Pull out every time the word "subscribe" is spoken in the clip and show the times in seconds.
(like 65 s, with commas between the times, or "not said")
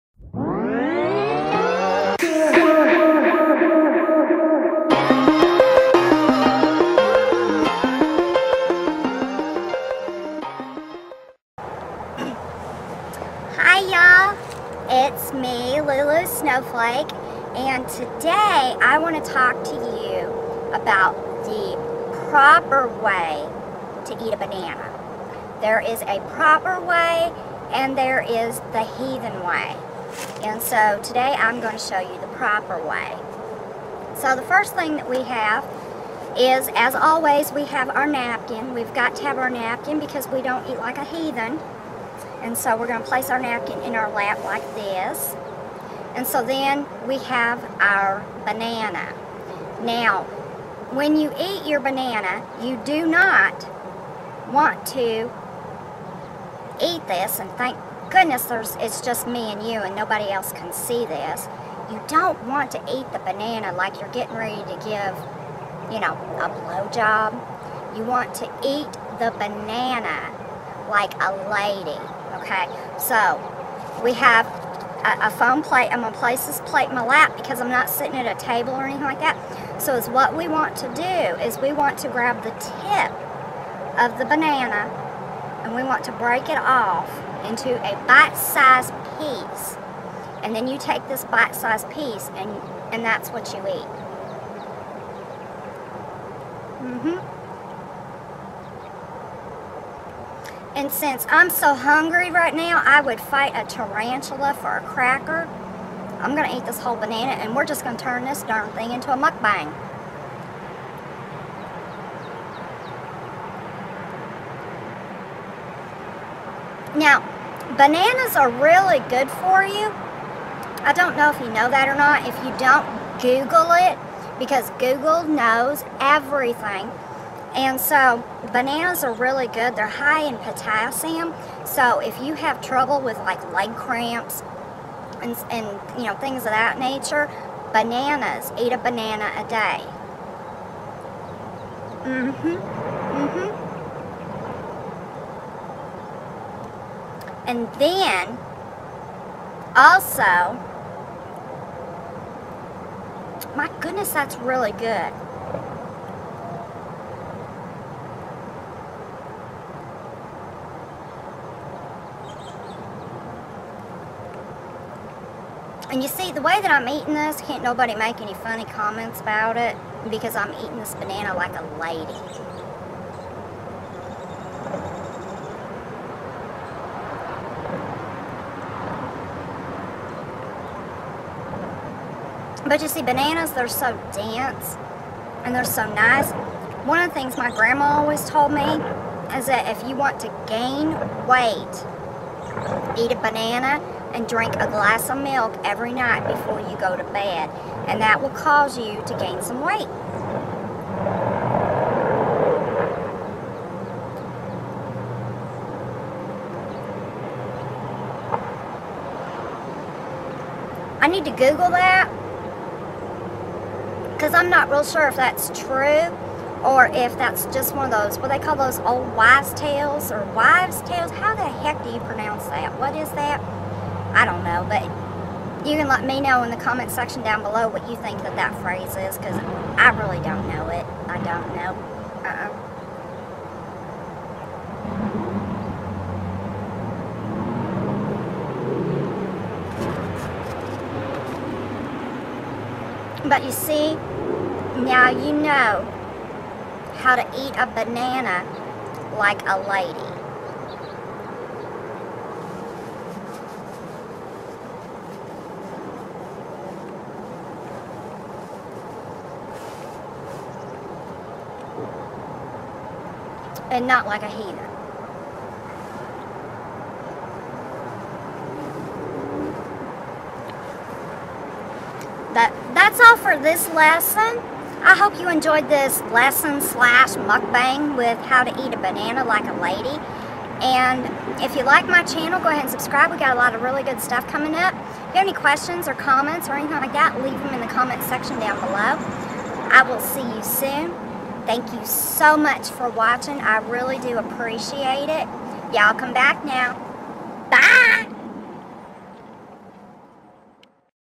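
282 s.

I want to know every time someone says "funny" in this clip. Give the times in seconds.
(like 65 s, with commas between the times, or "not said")
168 s.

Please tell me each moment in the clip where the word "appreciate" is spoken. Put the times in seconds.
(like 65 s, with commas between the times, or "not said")
294 s.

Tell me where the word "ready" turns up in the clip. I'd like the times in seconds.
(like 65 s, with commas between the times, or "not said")
64 s.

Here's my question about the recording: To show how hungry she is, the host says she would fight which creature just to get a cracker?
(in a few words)
A tarantula.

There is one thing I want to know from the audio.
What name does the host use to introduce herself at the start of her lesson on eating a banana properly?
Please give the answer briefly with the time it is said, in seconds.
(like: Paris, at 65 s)
Lulu Snowflake, at 15 s.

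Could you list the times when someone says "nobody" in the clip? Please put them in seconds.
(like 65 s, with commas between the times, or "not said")
59 s, 167 s.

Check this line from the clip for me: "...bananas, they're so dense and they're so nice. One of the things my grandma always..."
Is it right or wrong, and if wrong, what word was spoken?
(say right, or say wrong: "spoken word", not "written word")
right.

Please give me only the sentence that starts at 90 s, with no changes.
And then you take this bite-sized piece and, and that's what you eat.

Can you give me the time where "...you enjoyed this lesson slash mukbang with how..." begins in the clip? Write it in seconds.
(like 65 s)
275 s.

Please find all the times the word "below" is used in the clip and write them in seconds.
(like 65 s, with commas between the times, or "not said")
227 s, 288 s.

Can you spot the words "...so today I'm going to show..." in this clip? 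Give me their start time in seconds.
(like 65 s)
30 s.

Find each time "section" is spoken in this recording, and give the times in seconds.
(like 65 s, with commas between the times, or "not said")
226 s, 288 s.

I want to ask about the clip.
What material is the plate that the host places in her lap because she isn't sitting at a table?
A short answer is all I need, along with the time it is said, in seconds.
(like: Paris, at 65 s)
Foam, at 75 s.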